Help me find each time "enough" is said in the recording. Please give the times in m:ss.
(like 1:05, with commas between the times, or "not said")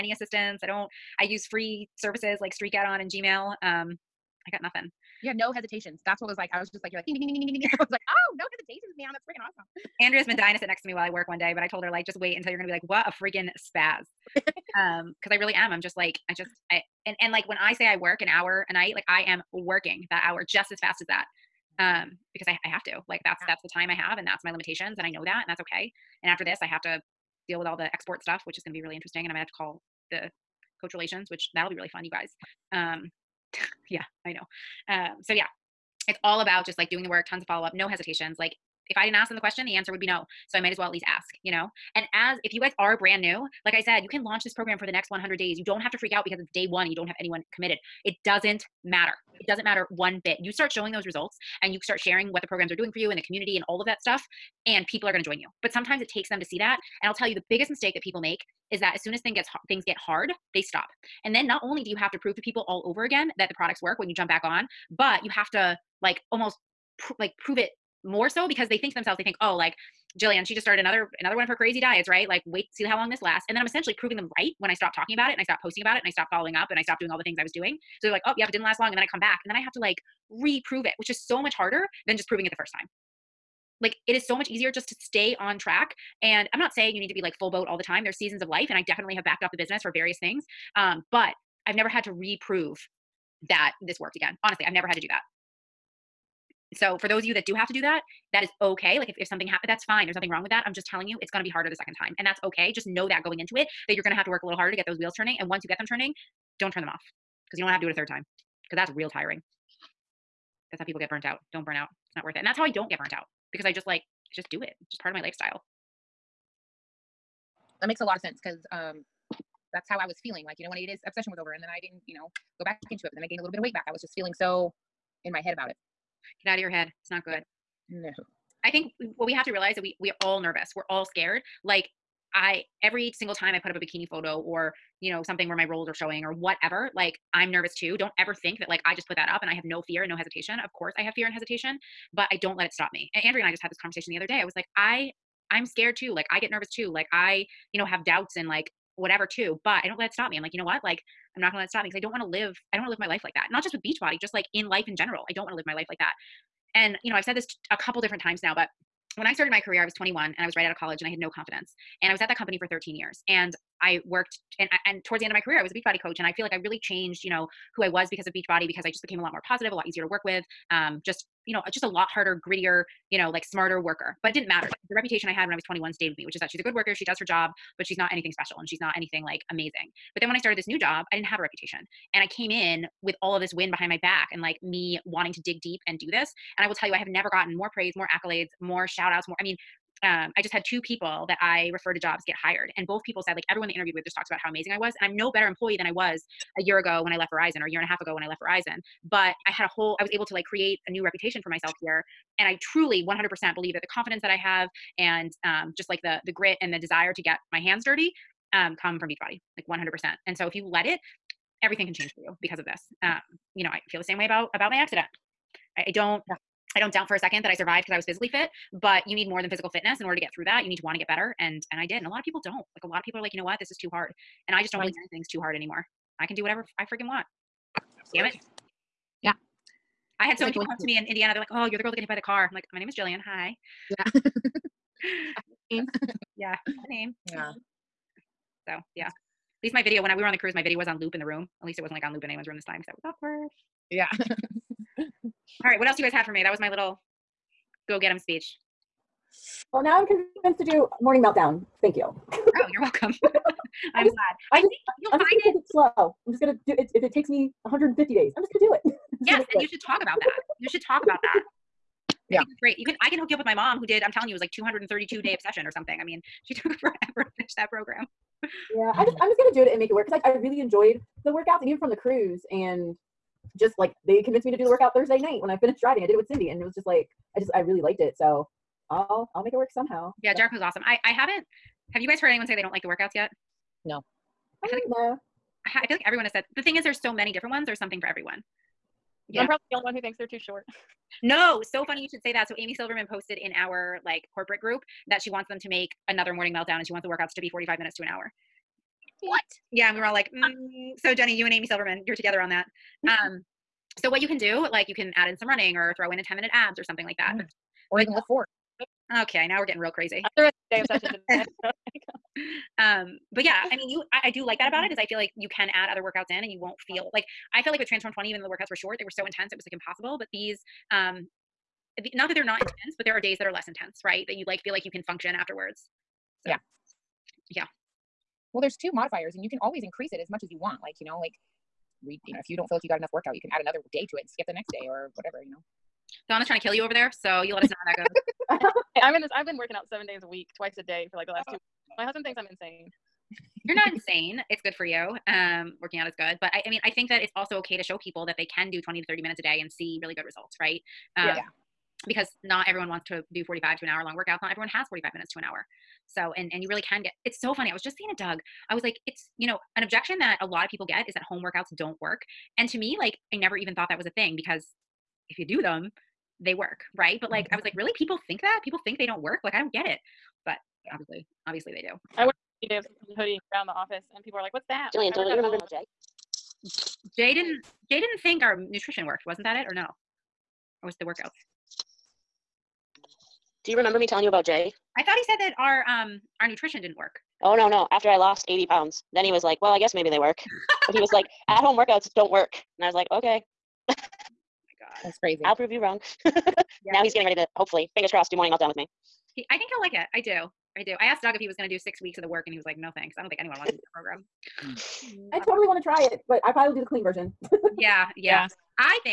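5:32.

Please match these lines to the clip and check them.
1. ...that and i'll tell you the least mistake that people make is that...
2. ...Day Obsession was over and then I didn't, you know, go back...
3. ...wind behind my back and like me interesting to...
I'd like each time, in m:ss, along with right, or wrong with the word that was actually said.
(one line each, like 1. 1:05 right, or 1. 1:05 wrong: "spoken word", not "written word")
1. 0:56 wrong: "biggest", not "least"
2. 2:00 right
3. 3:03 wrong: "wanting", not "interesting".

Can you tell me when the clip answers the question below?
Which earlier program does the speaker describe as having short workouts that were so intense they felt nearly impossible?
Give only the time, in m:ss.
5:17.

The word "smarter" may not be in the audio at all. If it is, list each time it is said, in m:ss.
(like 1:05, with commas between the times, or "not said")
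2:53.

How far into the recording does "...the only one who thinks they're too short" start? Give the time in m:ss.
4:49.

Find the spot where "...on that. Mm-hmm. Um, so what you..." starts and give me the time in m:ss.
5:02.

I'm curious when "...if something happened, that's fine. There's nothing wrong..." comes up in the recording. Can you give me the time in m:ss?
1:39.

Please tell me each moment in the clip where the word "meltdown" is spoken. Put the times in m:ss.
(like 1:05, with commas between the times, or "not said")
4:11, 4:56, 6:38.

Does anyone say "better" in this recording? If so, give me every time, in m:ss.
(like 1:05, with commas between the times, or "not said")
3:15, 3:41.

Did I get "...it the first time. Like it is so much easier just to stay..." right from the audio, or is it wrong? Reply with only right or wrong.
right.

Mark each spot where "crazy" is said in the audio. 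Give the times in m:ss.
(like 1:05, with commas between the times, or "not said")
1:11, 5:09, 6:35.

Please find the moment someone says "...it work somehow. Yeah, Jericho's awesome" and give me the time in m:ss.
4:39.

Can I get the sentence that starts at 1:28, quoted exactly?
There's seasons of life, and I definitely have backed off the business for various things.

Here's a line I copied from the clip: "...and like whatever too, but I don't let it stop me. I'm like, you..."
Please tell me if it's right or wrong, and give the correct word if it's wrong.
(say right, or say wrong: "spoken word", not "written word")
right.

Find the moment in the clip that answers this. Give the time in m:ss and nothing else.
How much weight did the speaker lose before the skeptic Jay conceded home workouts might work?
6:28.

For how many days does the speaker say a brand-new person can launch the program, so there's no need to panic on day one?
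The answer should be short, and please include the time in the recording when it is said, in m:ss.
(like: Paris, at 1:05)
100, at 0:45.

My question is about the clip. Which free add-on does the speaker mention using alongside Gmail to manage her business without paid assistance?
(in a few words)
Streak.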